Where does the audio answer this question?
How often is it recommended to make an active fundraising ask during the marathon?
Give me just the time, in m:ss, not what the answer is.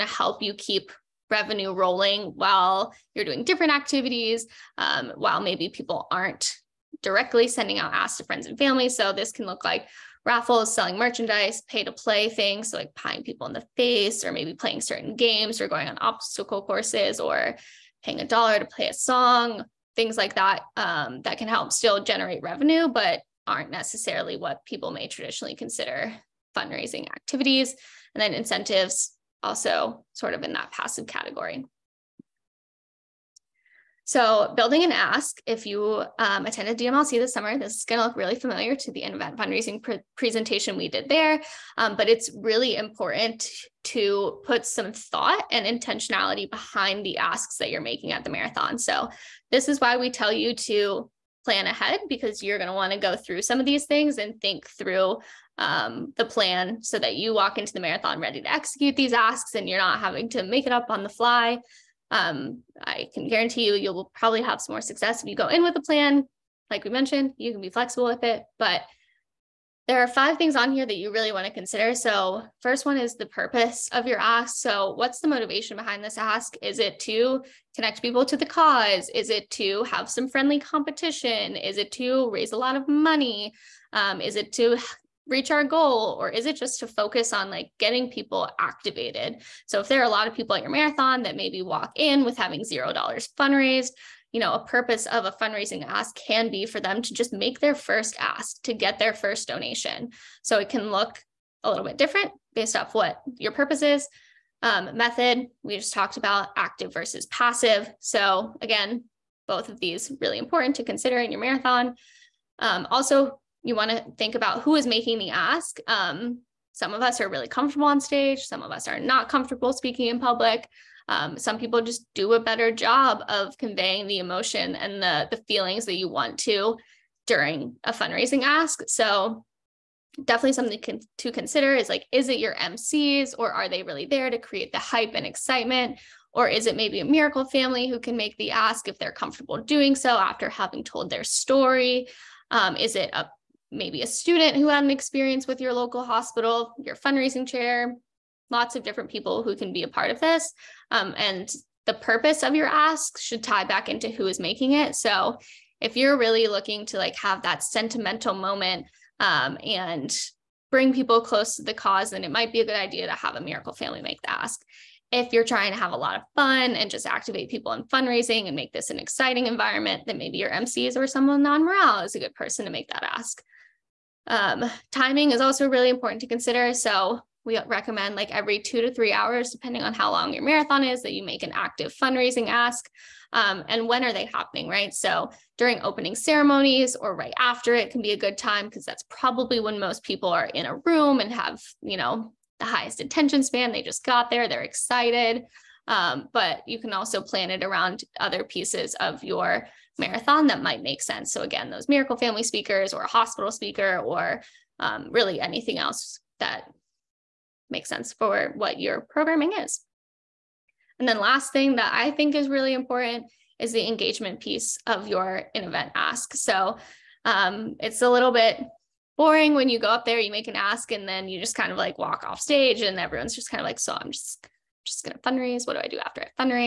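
2:58.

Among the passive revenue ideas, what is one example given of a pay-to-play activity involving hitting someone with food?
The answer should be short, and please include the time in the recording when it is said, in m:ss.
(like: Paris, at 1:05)
pieing people in the face, at 0:12.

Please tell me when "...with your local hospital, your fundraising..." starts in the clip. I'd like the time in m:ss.
2:25.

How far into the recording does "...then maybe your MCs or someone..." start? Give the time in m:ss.
2:50.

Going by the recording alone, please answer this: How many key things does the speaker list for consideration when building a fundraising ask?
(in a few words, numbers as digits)
5.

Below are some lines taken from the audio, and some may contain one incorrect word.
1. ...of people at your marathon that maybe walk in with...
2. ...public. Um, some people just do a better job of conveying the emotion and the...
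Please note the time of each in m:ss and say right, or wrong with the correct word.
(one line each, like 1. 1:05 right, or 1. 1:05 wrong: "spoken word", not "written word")
1. 1:30 right
2. 2:00 right.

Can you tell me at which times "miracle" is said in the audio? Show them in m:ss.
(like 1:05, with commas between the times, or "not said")
2:17, 2:43, 3:21.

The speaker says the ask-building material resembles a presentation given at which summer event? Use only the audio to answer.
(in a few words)
DMLC.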